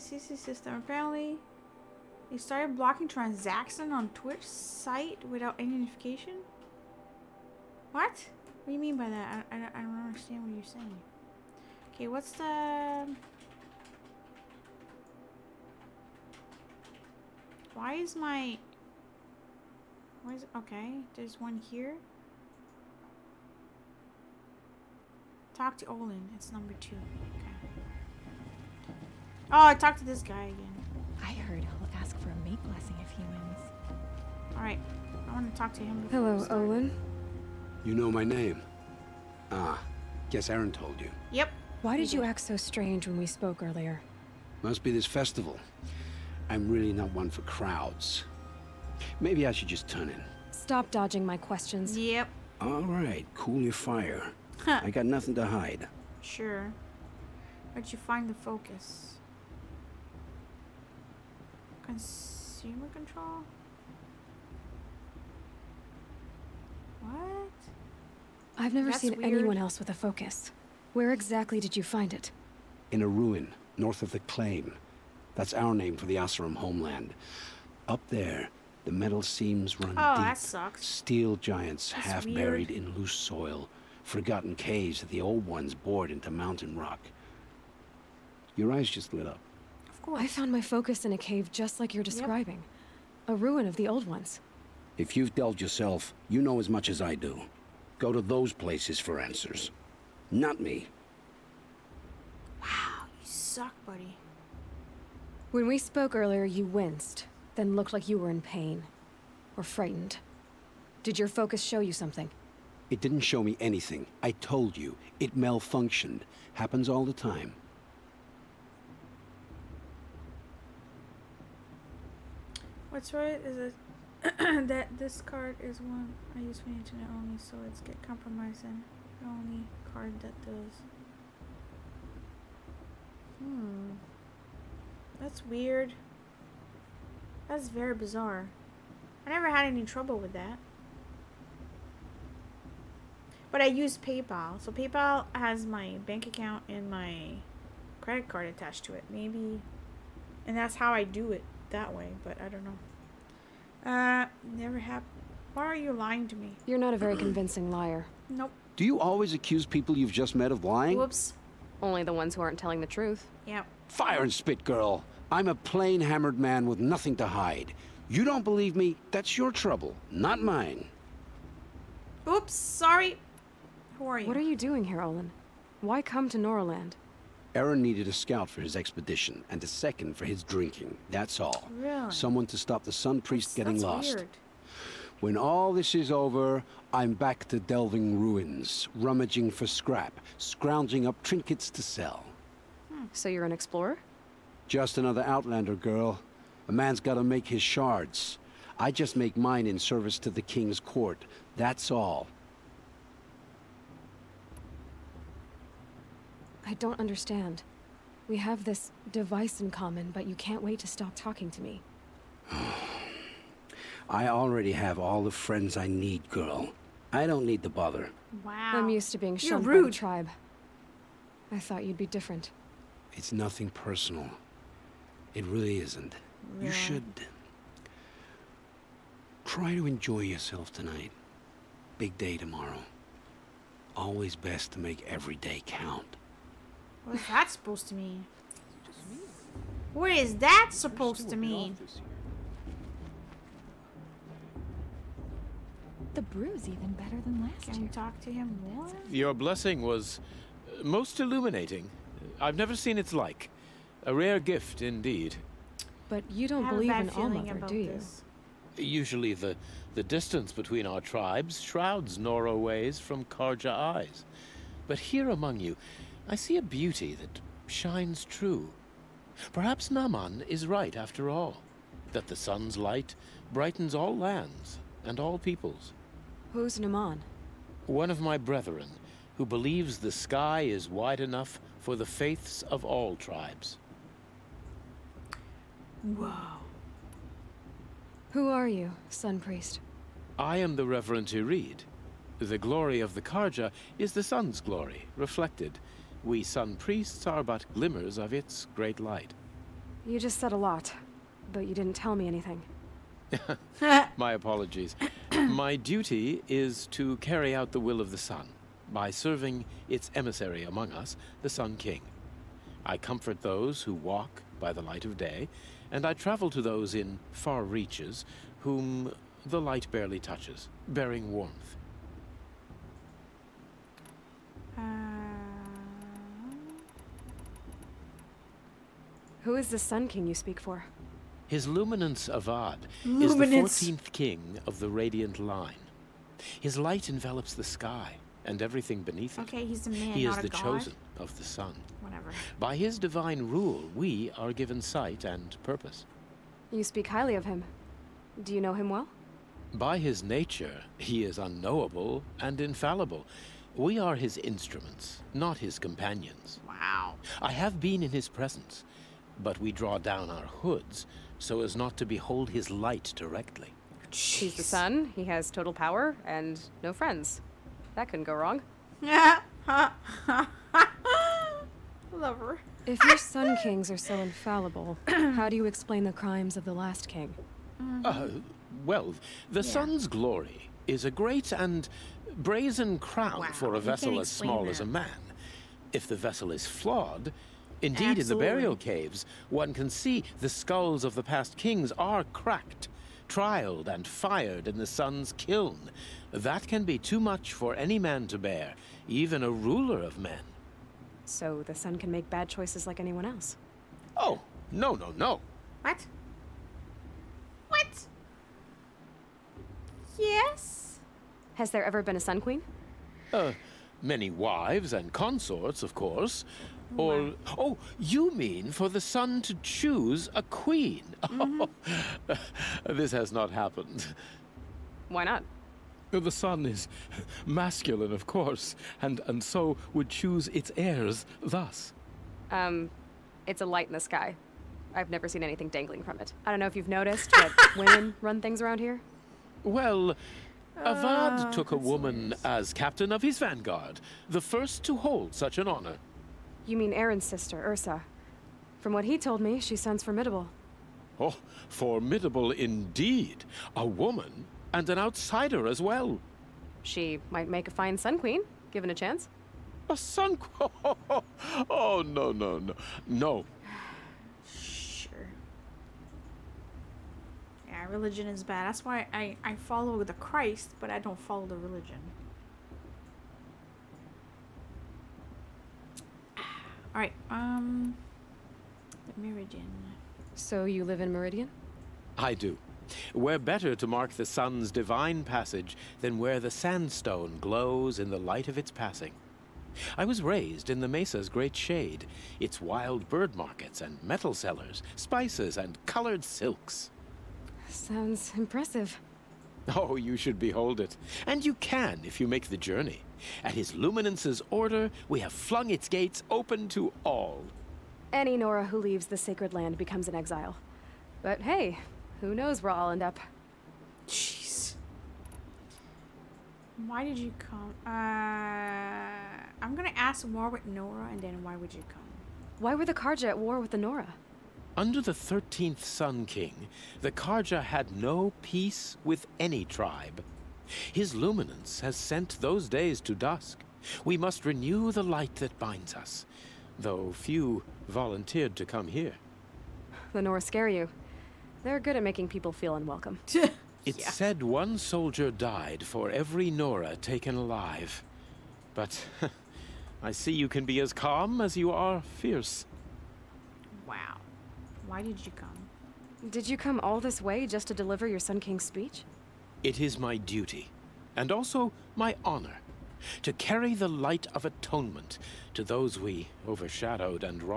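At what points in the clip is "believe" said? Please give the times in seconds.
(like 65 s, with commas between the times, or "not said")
168 s, 256 s, 279 s.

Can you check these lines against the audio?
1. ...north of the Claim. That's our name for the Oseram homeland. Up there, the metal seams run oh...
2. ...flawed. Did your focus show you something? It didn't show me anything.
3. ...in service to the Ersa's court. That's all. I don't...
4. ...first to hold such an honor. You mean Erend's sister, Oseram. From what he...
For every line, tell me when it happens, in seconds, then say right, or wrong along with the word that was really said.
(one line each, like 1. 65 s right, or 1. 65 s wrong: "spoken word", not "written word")
1. 73 s right
2. 109 s wrong: "frightened", not "flawed"
3. 199 s wrong: "King", not "Ersa"
4. 444 s wrong: "Ersa", not "Oseram".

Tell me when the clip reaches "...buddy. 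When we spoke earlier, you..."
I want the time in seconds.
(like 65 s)
103 s.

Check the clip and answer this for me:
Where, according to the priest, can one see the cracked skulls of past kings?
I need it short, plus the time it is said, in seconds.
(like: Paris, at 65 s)
the burial caves, at 388 s.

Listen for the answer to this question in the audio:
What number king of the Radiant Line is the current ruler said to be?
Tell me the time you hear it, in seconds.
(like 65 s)
333 s.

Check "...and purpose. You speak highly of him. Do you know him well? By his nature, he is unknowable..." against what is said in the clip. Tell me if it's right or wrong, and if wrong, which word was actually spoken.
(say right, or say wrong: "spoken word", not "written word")
right.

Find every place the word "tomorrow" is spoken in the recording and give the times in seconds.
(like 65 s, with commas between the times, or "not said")
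232 s.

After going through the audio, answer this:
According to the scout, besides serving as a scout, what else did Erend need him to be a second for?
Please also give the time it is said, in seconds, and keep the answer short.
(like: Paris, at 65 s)
his drinking, at 180 s.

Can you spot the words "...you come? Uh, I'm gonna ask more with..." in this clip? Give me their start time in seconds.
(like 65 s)
517 s.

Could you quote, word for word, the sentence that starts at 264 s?
But here among you, I see a beauty that shines true.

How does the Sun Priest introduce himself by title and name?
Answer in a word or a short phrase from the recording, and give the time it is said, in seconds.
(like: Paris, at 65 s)
Reverend Irid, at 290 s.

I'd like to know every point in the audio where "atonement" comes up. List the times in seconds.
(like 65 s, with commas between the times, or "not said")
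564 s.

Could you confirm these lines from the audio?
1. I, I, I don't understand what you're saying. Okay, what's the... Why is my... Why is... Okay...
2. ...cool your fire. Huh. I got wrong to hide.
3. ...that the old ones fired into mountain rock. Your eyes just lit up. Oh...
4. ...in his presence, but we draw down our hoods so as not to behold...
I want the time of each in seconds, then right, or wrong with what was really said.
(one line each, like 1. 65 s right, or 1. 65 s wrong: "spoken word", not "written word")
1. 9 s right
2. 53 s wrong: "nothing", not "wrong"
3. 85 s wrong: "bored", not "fired"
4. 358 s right.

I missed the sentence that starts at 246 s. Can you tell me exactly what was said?
The brew's even better than last Can year.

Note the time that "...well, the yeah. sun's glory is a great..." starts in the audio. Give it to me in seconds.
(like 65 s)
378 s.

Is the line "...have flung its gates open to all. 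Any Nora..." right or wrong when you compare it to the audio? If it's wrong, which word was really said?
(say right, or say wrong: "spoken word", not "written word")
right.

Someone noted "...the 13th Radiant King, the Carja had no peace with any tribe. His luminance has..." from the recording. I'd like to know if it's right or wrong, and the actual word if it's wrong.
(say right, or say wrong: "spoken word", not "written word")
wrong: "Sun", not "Radiant".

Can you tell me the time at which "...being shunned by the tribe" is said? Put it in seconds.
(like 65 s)
219 s.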